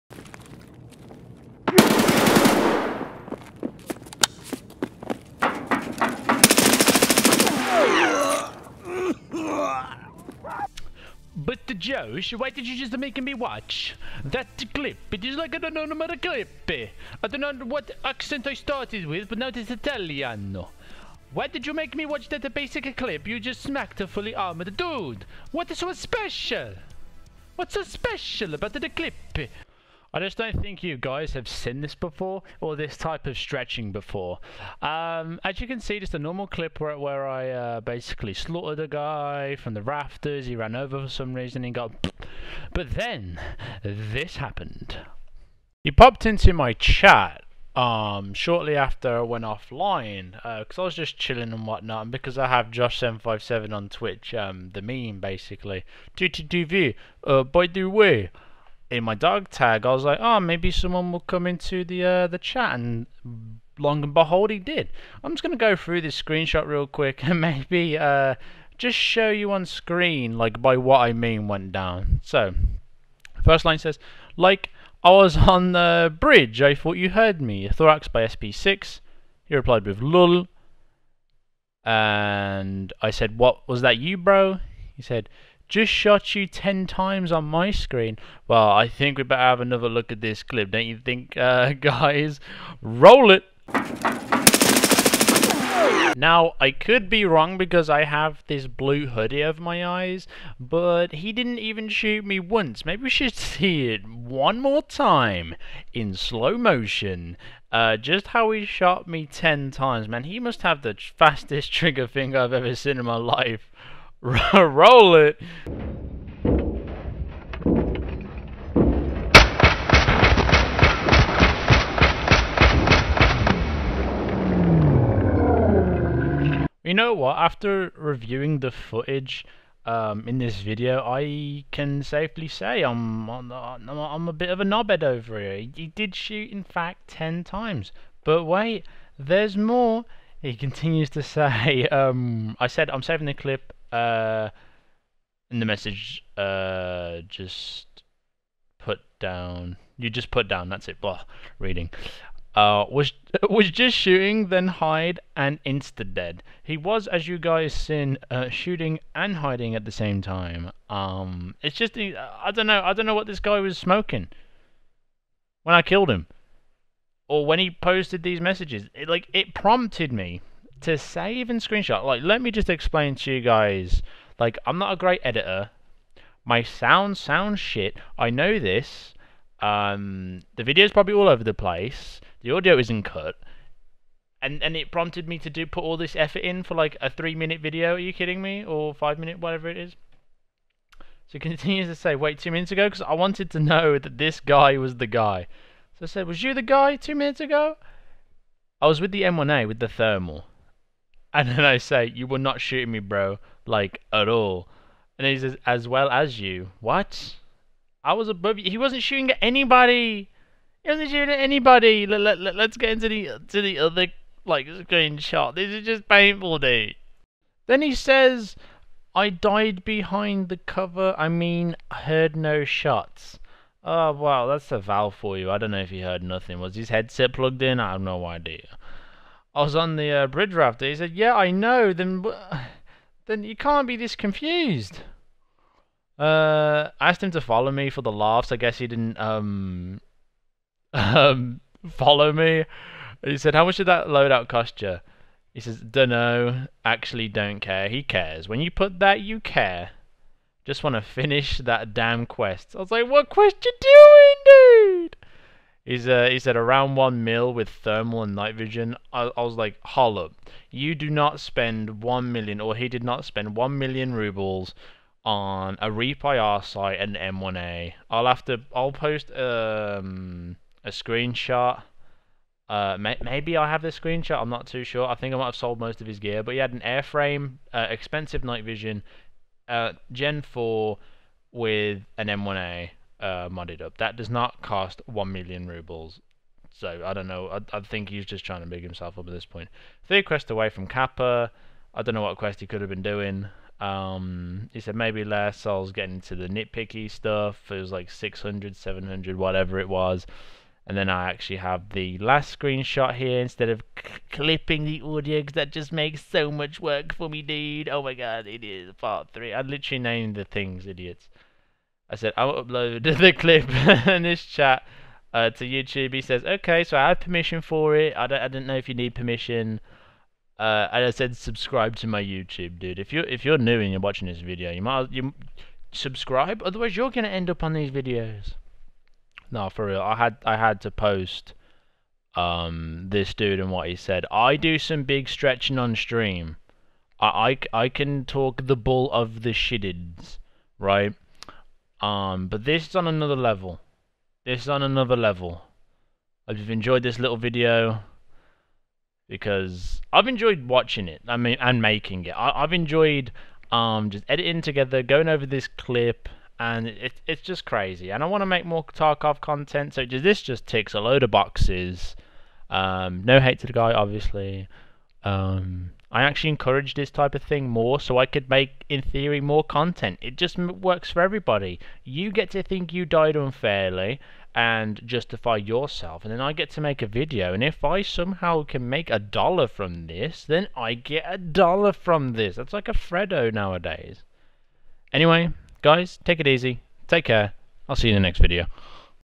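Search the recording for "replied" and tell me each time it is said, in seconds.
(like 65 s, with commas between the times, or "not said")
79 s.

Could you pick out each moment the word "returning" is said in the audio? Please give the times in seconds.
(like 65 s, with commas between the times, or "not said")
not said.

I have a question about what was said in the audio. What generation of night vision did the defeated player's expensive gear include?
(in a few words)
Gen 4.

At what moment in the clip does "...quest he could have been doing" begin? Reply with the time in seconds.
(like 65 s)
292 s.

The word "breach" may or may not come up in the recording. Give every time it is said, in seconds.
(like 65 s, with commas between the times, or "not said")
not said.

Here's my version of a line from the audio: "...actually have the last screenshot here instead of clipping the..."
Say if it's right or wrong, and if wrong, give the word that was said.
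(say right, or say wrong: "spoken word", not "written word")
right.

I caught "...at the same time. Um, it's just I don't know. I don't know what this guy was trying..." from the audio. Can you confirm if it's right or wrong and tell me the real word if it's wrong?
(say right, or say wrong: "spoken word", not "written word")
wrong: "smoking", not "trying".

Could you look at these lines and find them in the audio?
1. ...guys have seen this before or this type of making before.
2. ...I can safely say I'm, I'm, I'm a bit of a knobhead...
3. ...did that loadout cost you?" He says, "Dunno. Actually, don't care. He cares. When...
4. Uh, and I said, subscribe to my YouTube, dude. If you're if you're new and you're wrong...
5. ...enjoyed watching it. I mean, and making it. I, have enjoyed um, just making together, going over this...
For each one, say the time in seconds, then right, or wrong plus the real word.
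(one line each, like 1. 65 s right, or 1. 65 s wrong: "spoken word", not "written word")
1. 30 s wrong: "stretching", not "making"
2. 131 s right
3. 243 s right
4. 320 s wrong: "watching", not "wrong"
5. 350 s wrong: "editing", not "making".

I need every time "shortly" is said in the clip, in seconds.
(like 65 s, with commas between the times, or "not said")
48 s.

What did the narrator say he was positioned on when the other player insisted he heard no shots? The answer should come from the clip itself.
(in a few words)
bridge rafter.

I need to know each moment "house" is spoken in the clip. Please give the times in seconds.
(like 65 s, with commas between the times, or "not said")
not said.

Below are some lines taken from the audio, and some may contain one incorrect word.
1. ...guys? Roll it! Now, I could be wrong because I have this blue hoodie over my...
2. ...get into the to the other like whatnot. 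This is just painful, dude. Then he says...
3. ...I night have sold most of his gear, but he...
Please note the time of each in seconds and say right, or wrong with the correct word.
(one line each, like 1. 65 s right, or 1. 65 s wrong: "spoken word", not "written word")
1. 91 s right
2. 212 s wrong: "screenshot", not "whatnot"
3. 275 s wrong: "might", not "night".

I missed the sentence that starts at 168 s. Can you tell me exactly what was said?
It, like it prompted me to save and screenshot.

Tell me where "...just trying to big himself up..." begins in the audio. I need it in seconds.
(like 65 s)
288 s.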